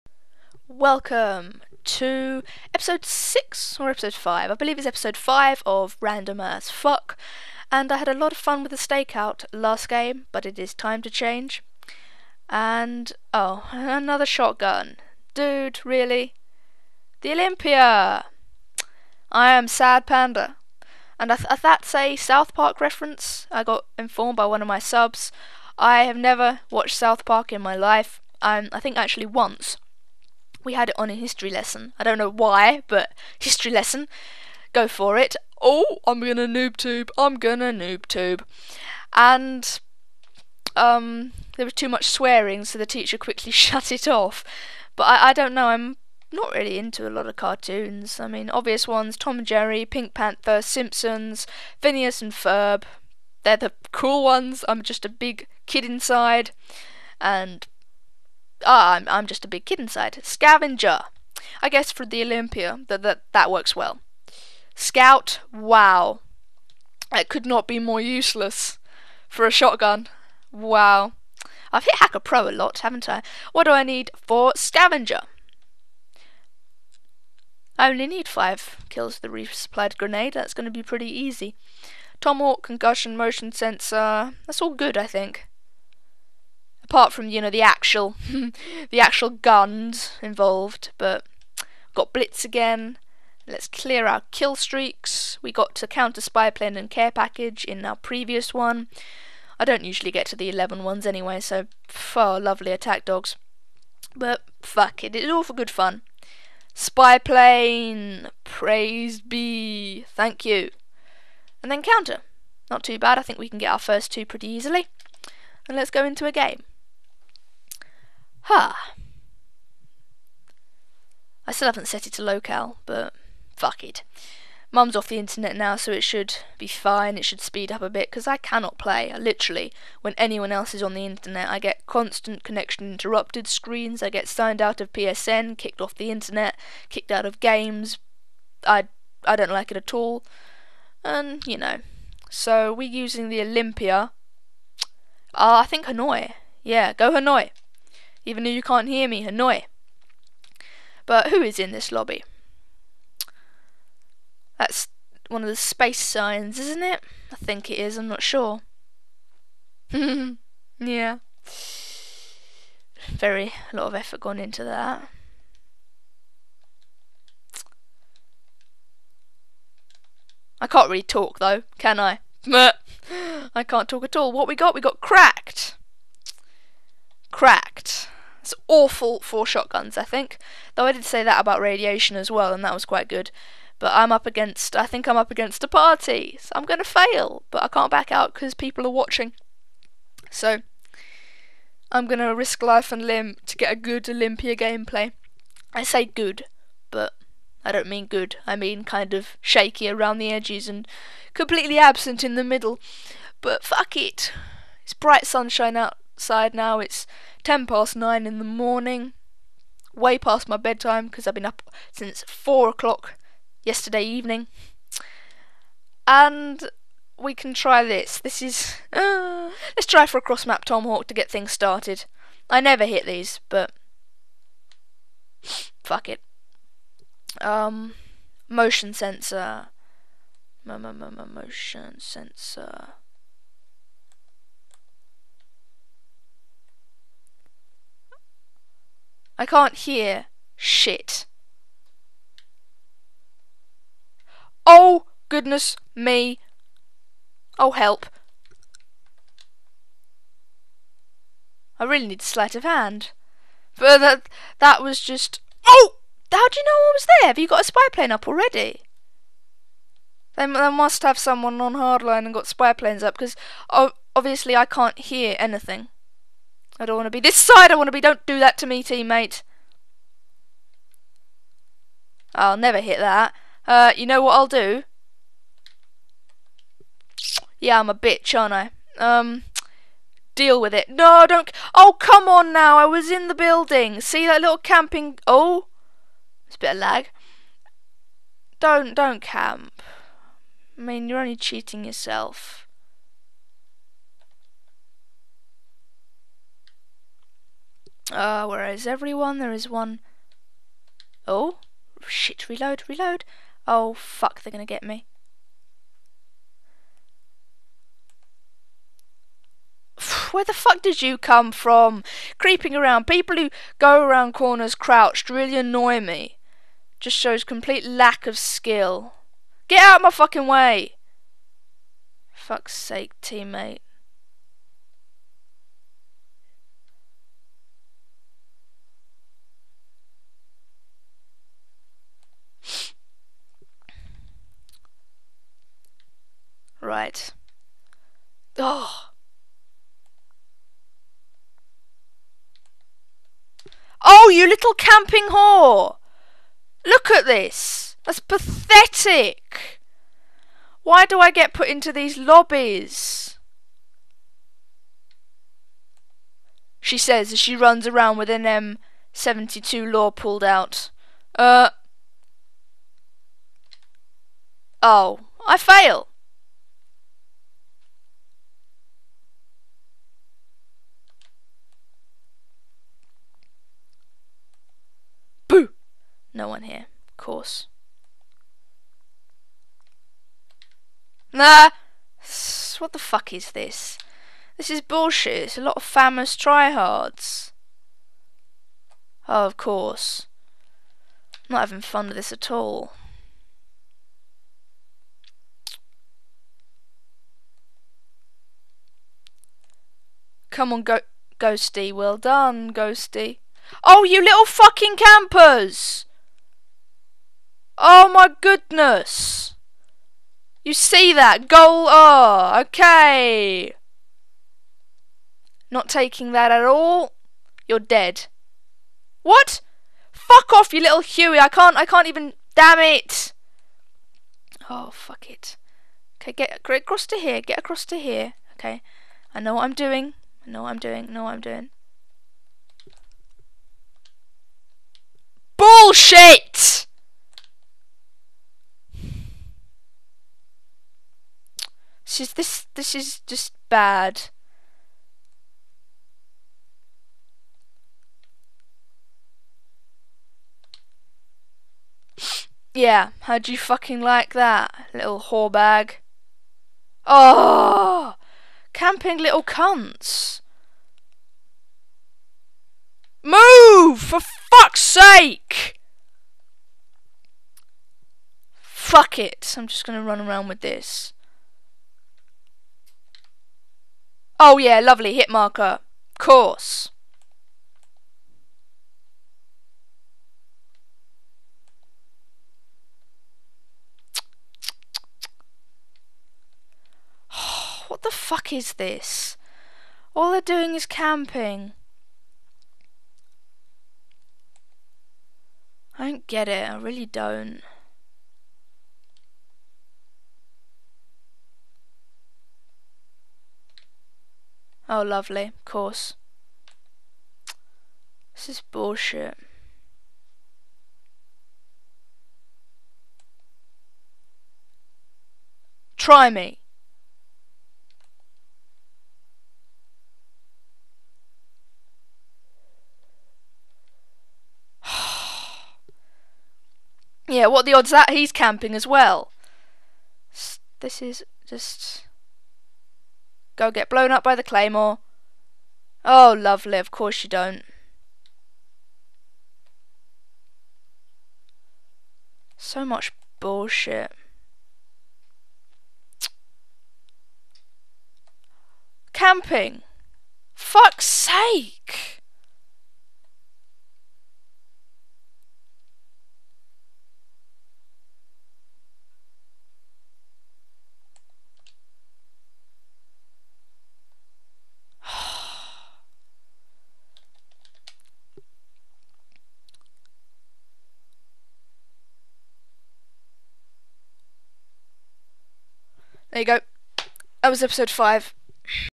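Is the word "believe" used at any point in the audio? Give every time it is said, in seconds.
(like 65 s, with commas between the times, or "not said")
4 s.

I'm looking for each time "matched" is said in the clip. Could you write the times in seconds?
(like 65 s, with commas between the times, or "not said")
not said.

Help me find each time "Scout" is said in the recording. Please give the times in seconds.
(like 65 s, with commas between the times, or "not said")
64 s.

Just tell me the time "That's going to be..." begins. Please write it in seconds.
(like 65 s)
80 s.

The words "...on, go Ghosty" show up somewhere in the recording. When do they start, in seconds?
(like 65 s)
400 s.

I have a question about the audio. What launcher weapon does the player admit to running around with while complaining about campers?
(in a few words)
M72 LAW.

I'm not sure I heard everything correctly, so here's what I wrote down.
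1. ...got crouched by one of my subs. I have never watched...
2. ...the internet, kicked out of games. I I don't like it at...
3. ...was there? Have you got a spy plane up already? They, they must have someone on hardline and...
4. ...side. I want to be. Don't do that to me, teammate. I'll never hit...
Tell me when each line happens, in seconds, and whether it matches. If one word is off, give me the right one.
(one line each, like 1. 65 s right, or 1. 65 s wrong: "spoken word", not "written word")
1. 23 s wrong: "informed", not "crouched"
2. 135 s right
3. 256 s right
4. 267 s right.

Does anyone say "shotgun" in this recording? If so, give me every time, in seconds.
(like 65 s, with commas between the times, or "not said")
14 s, 69 s, 179 s.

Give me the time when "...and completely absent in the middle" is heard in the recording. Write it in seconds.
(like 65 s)
200 s.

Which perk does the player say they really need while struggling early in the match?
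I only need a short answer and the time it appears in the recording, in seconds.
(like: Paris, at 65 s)
Sleight of Hand, at 252 s.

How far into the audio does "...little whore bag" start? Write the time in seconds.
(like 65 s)
454 s.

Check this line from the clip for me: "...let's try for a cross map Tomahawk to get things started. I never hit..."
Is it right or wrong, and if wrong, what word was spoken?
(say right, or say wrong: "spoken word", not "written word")
right.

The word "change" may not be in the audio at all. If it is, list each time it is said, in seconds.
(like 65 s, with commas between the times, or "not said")
11 s.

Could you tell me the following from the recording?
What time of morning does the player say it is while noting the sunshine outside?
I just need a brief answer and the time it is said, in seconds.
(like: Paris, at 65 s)
10 past 9, at 207 s.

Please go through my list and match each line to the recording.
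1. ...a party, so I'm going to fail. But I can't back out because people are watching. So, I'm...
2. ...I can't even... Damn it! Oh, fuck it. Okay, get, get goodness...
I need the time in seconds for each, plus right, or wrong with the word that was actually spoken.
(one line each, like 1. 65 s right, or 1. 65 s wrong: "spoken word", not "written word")
1. 185 s right
2. 421 s wrong: "across", not "goodness".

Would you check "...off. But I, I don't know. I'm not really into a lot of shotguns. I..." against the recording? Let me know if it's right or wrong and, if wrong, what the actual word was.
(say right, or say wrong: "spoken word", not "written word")
wrong: "cartoons", not "shotguns".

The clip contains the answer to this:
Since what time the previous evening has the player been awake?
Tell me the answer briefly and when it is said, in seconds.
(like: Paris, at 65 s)
4 o'clock, at 212 s.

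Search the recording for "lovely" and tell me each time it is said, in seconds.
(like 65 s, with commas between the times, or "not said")
102 s, 474 s, 505 s, 536 s.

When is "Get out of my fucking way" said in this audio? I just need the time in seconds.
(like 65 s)
319 s.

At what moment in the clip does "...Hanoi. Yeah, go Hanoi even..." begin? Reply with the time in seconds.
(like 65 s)
145 s.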